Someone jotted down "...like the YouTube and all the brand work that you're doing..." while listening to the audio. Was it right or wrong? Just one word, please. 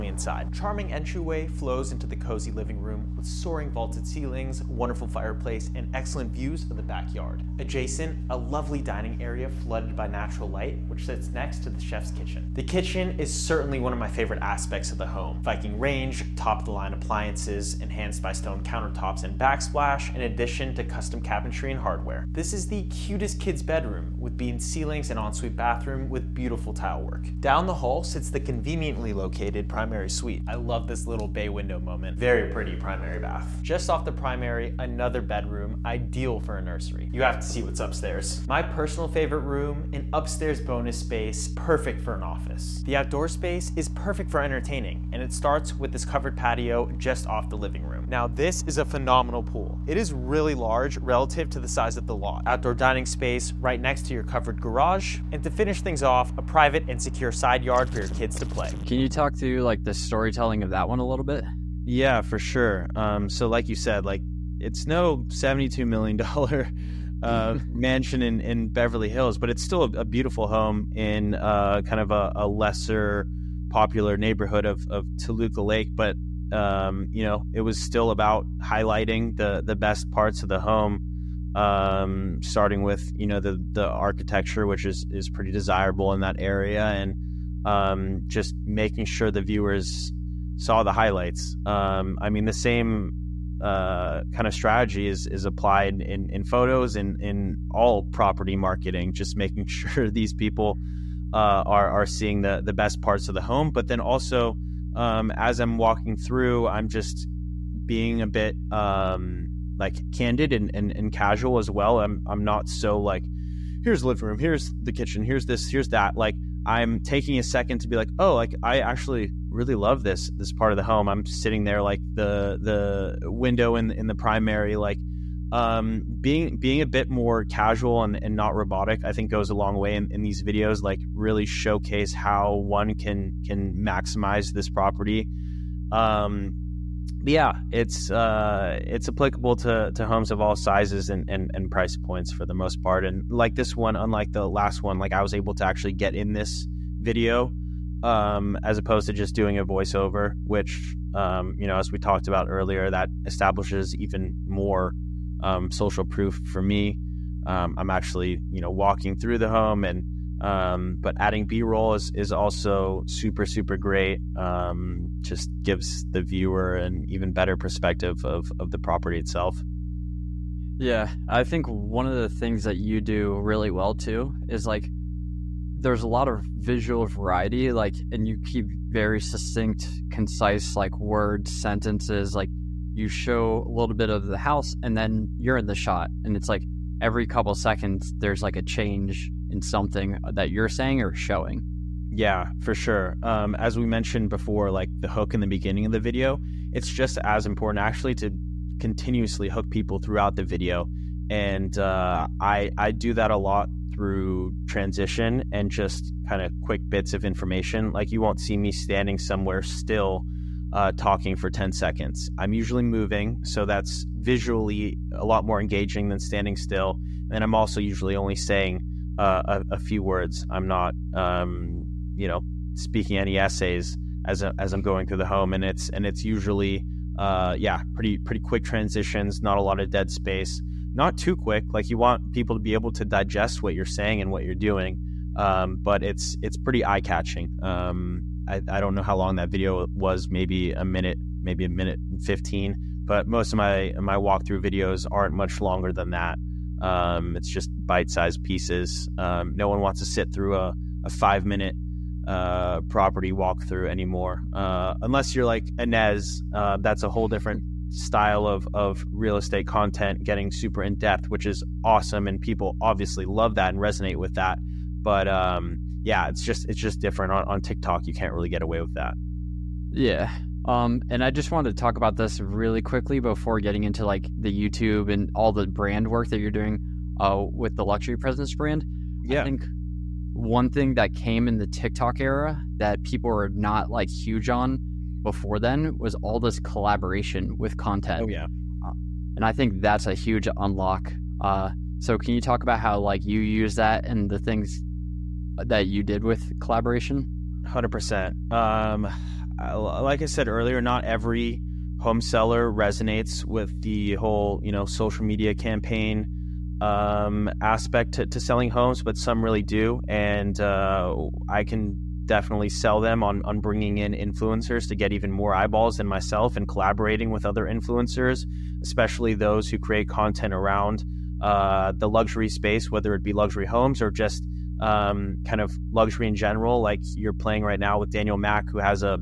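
right.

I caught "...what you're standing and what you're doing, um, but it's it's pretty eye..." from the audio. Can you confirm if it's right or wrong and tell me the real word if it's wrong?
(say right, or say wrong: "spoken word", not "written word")
wrong: "saying", not "standing".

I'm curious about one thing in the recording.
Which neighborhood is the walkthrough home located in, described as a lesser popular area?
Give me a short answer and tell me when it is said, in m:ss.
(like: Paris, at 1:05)
Toluca Lake, at 1:15.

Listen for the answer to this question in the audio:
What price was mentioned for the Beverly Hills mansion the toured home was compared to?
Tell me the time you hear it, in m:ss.
1:05.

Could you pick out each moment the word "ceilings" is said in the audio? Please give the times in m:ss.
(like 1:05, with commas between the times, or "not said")
0:04, 0:24.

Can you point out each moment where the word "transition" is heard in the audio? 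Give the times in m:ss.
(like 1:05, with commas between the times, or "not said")
3:24, 3:48.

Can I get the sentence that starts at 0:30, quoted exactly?
I love this little bay window moment.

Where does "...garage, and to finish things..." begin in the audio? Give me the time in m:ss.
0:54.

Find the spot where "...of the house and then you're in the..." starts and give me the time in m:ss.
3:04.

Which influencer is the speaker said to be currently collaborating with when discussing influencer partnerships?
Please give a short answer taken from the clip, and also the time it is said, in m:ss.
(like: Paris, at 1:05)
Daniel Mac, at 5:28.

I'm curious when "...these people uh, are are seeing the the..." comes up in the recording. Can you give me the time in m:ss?
1:40.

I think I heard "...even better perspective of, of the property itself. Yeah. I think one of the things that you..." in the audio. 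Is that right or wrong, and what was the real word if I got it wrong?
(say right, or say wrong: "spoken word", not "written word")
right.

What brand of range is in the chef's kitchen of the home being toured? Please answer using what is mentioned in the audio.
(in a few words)
Viking.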